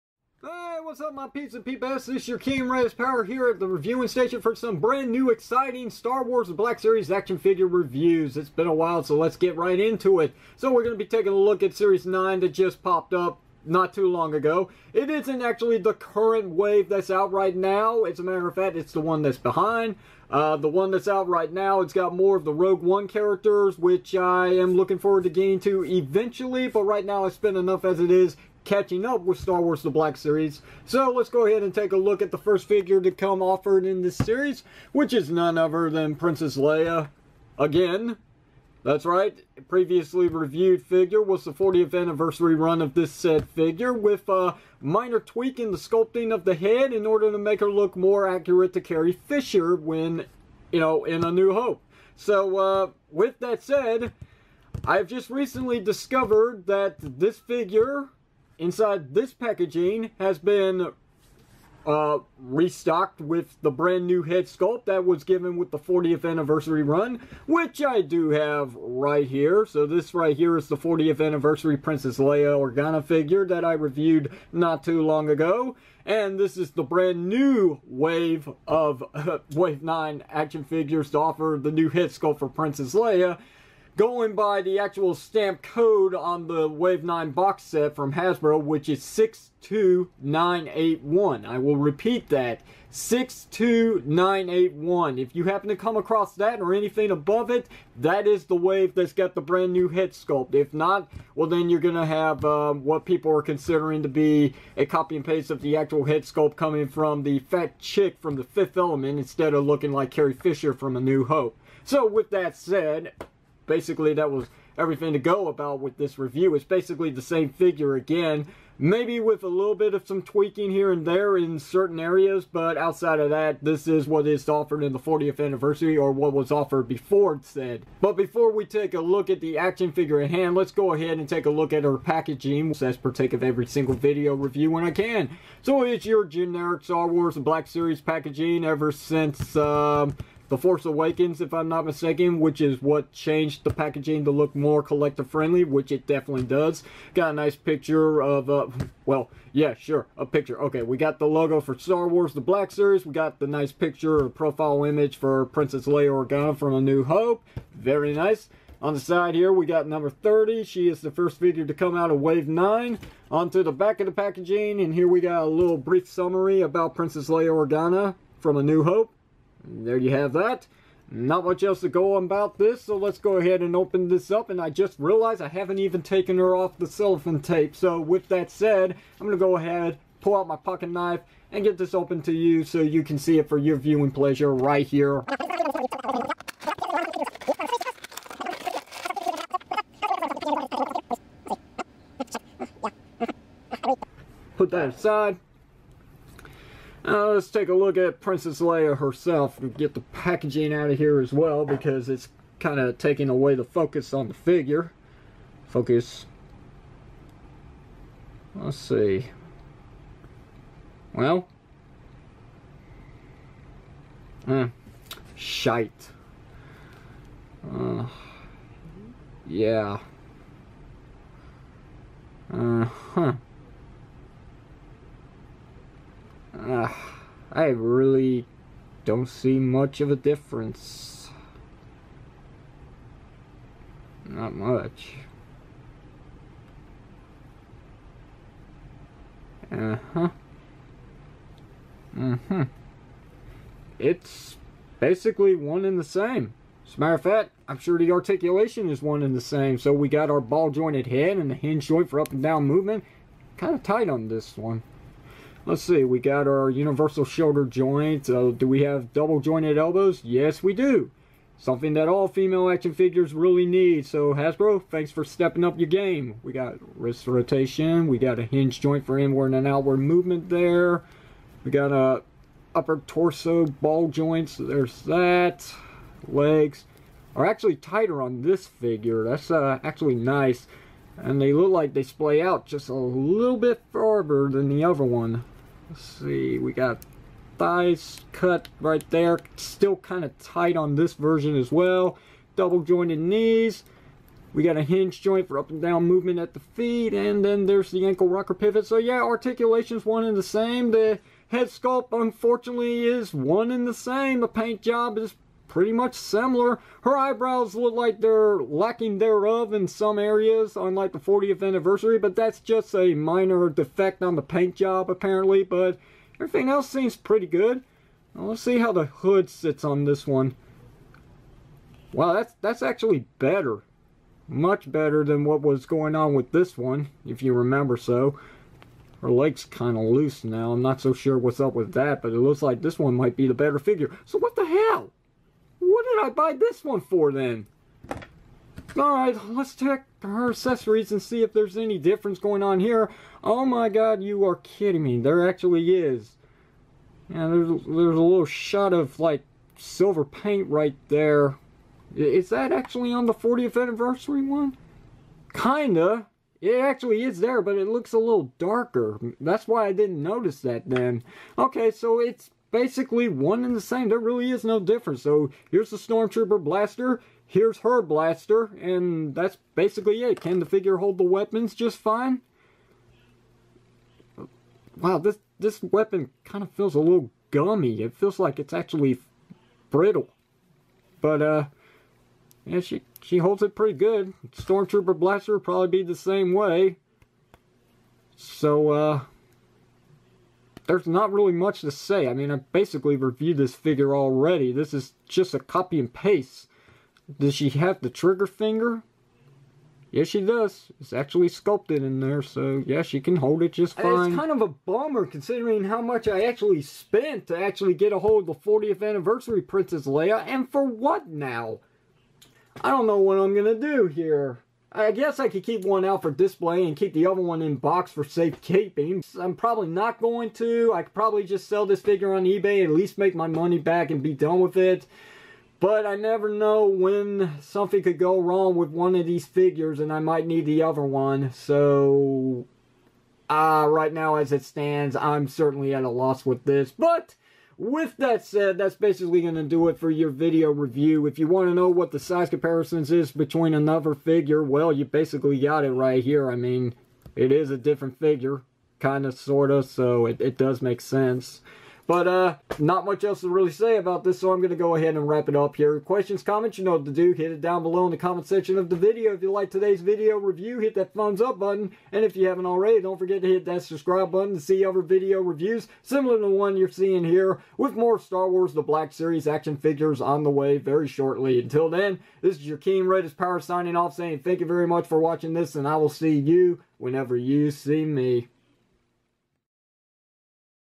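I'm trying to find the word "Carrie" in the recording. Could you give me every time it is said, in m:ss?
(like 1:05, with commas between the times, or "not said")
0:48, 1:50.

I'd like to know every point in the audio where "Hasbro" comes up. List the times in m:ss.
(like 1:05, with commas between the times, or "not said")
1:28, 4:24.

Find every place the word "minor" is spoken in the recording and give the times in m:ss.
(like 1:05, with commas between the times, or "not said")
0:44, 5:13.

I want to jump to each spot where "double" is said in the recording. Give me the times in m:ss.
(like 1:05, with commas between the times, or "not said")
4:19, 4:52.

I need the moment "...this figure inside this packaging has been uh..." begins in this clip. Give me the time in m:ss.
0:56.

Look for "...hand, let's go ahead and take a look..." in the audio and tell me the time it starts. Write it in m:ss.
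2:10.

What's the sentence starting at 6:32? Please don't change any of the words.
I mean, I basically reviewed this figure already.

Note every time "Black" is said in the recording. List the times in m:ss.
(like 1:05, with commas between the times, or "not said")
0:06, 0:29, 2:17, 2:32, 7:48.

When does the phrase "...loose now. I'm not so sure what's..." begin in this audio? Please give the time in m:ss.
5:30.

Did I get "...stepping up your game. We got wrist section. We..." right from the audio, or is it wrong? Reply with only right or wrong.
wrong.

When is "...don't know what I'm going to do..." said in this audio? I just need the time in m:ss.
6:52.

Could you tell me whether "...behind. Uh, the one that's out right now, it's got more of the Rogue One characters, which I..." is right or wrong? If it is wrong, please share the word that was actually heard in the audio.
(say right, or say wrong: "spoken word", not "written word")
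right.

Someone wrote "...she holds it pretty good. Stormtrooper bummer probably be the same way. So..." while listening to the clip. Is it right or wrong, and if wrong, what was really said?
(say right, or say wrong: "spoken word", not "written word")
wrong: "blaster", not "bummer".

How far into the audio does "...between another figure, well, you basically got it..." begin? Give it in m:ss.
7:23.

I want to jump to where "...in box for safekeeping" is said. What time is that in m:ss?
6:57.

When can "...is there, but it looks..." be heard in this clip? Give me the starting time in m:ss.
5:57.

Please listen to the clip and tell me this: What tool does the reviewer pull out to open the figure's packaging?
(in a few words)
Pocket knife.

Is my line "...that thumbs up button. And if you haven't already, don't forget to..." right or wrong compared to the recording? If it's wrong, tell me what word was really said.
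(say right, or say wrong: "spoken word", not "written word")
right.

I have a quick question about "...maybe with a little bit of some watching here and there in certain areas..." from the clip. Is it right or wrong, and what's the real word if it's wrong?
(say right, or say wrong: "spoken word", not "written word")
wrong: "tweaking", not "watching".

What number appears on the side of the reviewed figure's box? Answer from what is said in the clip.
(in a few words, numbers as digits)
30.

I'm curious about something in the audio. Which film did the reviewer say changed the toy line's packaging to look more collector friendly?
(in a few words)
The Force Awakens.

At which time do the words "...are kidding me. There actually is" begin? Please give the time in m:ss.
5:44.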